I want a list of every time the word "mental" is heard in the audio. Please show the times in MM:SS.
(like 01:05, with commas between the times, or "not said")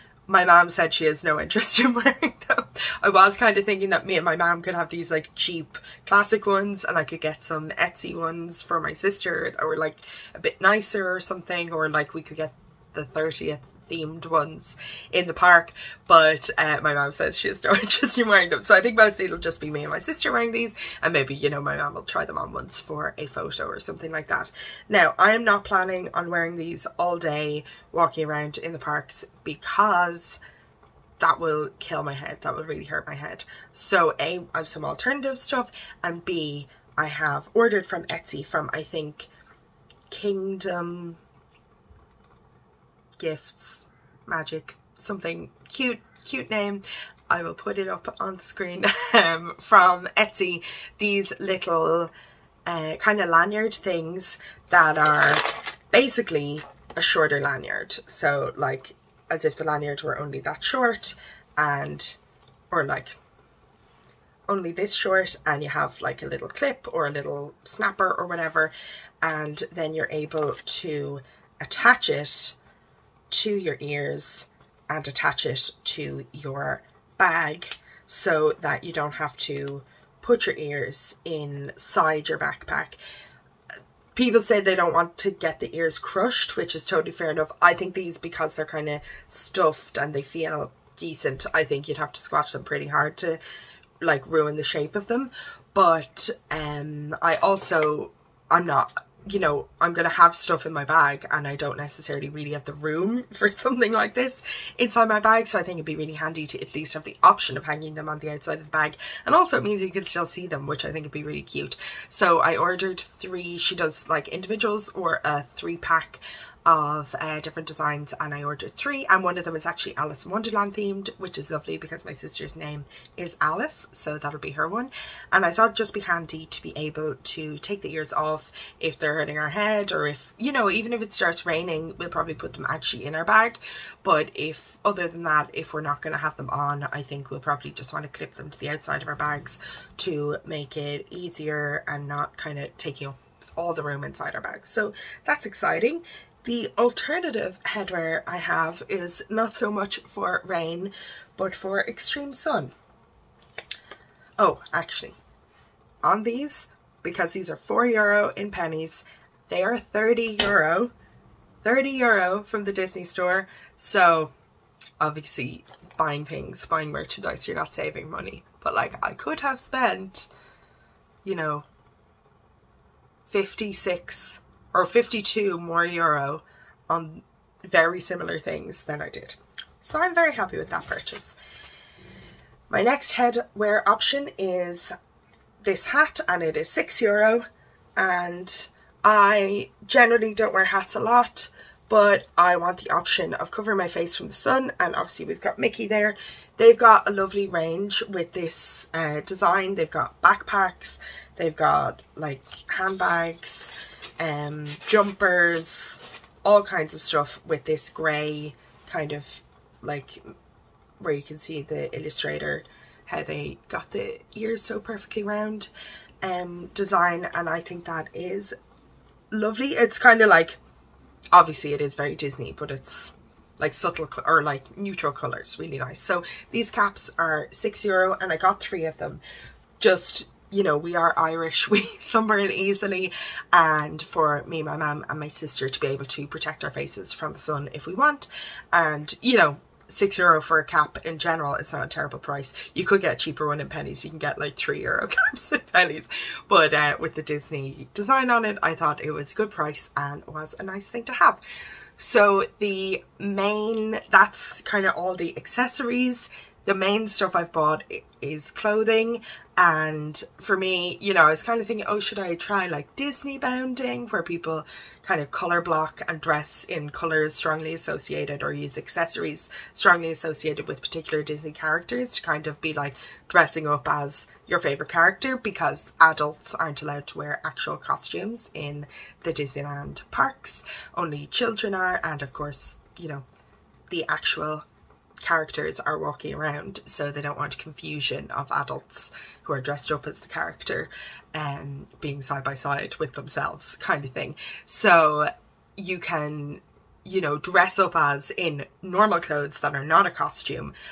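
not said.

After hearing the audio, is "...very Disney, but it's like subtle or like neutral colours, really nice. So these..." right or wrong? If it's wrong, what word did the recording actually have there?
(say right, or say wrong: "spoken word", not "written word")
right.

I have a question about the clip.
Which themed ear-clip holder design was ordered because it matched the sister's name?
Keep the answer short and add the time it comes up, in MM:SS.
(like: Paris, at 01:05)
Alice in Wonderland, at 01:59.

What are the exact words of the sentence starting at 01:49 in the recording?
And also it means you can still see them, which I think would be really cute.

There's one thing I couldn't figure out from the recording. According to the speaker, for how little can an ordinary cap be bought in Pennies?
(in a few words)
3 euro.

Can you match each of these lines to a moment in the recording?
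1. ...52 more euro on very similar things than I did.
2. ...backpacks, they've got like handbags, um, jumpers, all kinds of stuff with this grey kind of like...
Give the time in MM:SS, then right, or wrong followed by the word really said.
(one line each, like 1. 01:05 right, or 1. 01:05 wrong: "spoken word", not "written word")
1. 02:54 right
2. 03:20 right.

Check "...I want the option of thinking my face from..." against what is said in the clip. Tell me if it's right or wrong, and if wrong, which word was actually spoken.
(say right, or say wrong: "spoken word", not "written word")
wrong: "covering", not "thinking".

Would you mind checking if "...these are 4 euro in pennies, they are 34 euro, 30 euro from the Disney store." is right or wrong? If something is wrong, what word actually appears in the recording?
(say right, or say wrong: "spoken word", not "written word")
wrong: "30", not "34".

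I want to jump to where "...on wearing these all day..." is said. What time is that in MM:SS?
00:26.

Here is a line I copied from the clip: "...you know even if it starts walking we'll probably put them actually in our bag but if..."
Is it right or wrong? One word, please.
wrong.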